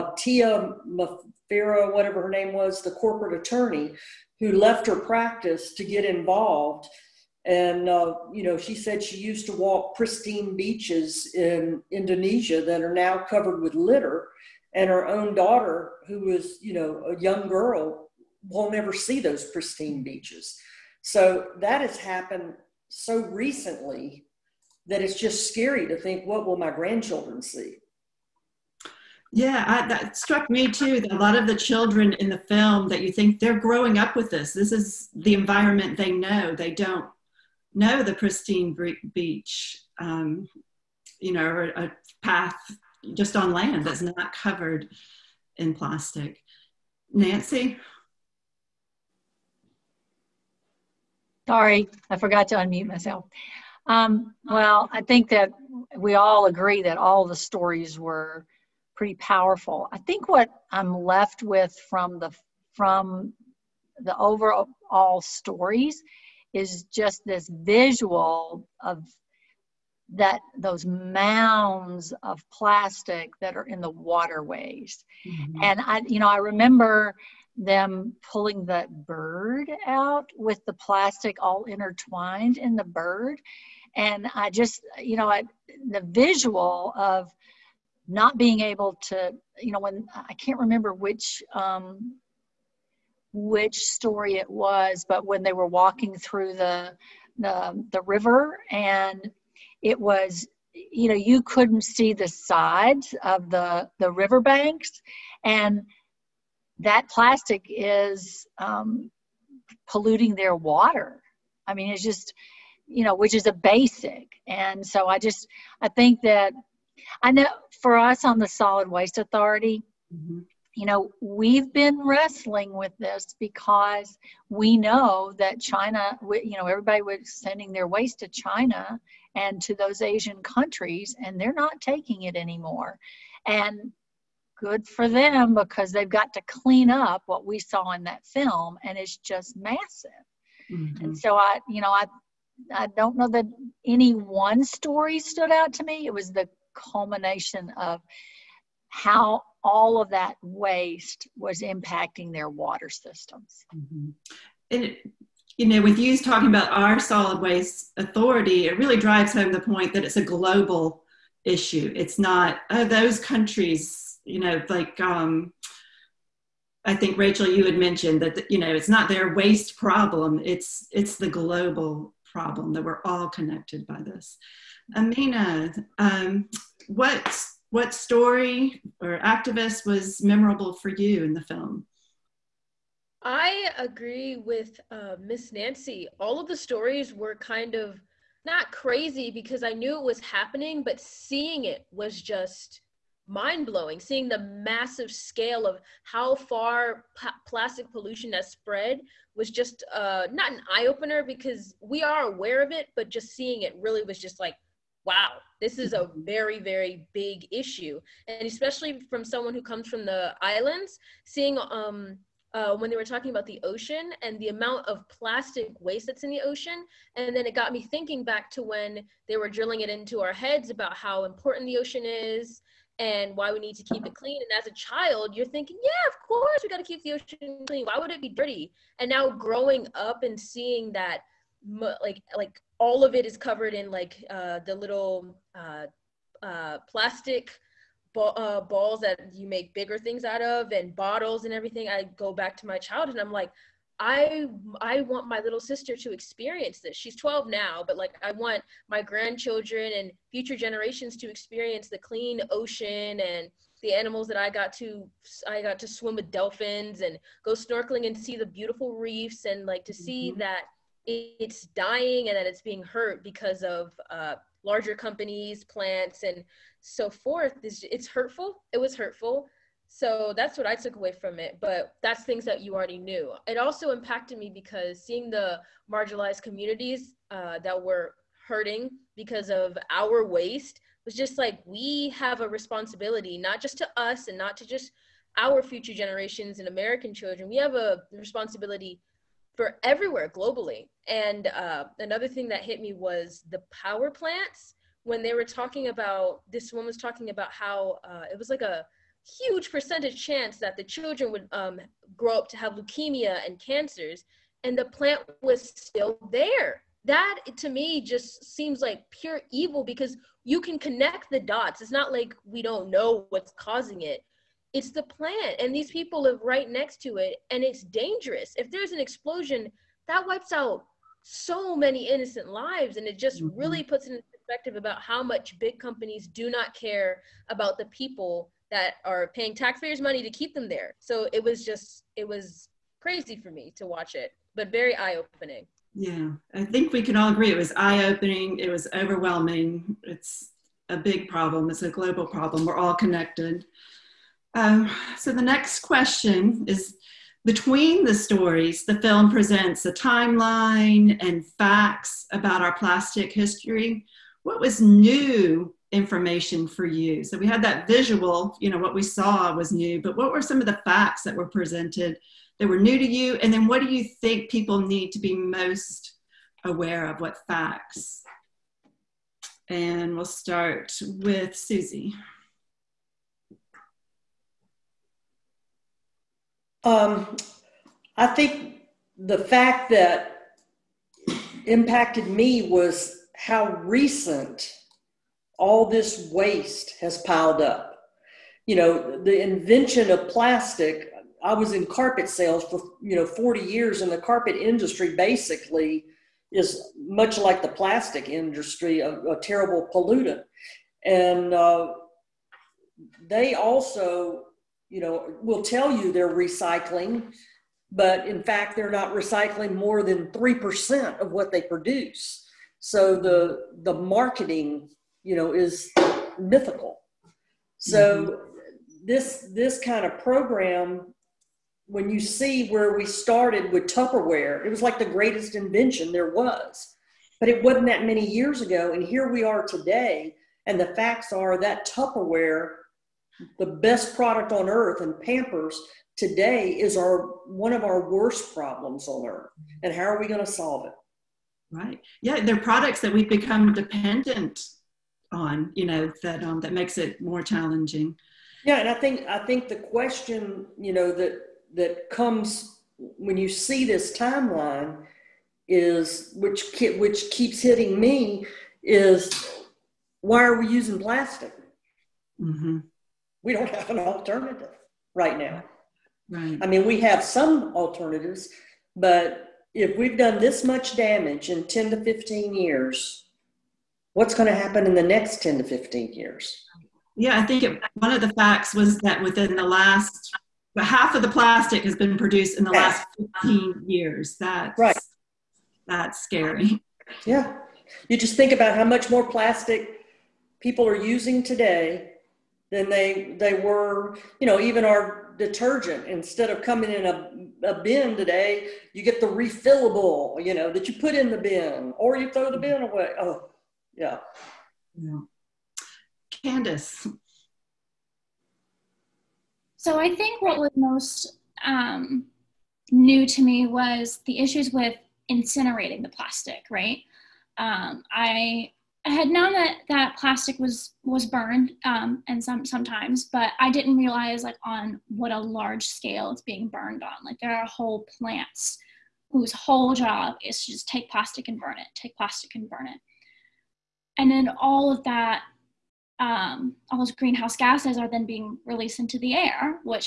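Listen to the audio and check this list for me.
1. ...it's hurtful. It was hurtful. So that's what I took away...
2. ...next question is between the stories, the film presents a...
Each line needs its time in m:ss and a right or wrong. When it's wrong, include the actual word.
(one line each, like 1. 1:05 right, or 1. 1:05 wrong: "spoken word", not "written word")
1. 4:27 right
2. 5:45 right.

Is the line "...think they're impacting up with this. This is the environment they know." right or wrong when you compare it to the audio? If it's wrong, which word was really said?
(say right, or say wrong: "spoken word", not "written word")
wrong: "growing", not "impacting".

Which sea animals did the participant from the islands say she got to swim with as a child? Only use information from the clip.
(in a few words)
Dolphins.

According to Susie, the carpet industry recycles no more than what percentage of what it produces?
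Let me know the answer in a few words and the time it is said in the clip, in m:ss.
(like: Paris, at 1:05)
3%, at 6:50.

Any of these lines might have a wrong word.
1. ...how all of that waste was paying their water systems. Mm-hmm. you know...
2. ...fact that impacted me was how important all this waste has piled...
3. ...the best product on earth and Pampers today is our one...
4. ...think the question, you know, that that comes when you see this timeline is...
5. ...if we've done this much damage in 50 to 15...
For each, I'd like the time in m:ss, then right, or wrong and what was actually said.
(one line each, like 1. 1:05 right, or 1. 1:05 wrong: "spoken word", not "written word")
1. 2:28 wrong: "impacting", not "paying"
2. 6:19 wrong: "recent", not "important"
3. 7:13 right
4. 7:29 right
5. 7:49 wrong: "10", not "50".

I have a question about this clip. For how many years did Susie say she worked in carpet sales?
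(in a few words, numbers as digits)
40.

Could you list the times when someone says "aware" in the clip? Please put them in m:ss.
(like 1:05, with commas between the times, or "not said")
3:22, 6:06.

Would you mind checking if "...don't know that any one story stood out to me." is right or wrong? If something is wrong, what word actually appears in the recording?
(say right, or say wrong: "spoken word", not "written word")
right.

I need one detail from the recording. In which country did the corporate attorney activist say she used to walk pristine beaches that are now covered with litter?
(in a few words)
Indonesia.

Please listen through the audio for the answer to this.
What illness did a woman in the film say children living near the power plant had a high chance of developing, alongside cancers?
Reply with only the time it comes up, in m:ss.
5:02.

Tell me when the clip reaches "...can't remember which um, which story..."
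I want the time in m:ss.
1:30.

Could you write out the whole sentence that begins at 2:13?
And good for them because they've got to clean up what we saw in that film, and it's just massive.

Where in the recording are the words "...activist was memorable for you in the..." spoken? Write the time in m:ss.
2:59.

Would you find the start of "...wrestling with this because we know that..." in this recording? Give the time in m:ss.
2:02.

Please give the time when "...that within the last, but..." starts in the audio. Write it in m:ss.
7:58.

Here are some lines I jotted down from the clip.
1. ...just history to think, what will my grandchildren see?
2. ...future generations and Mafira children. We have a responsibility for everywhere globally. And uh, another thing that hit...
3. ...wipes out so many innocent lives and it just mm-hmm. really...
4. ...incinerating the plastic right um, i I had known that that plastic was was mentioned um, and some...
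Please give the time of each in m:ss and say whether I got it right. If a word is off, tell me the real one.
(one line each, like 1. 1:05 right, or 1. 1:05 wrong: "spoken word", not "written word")
1. 0:25 wrong: "scary", not "history"
2. 4:45 wrong: "American", not "Mafira"
3. 5:20 right
4. 8:35 wrong: "burned", not "mentioned".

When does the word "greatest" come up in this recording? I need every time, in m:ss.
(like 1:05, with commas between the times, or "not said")
7:05.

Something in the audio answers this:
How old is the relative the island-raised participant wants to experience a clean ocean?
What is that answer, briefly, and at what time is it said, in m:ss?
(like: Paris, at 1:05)
12, at 4:07.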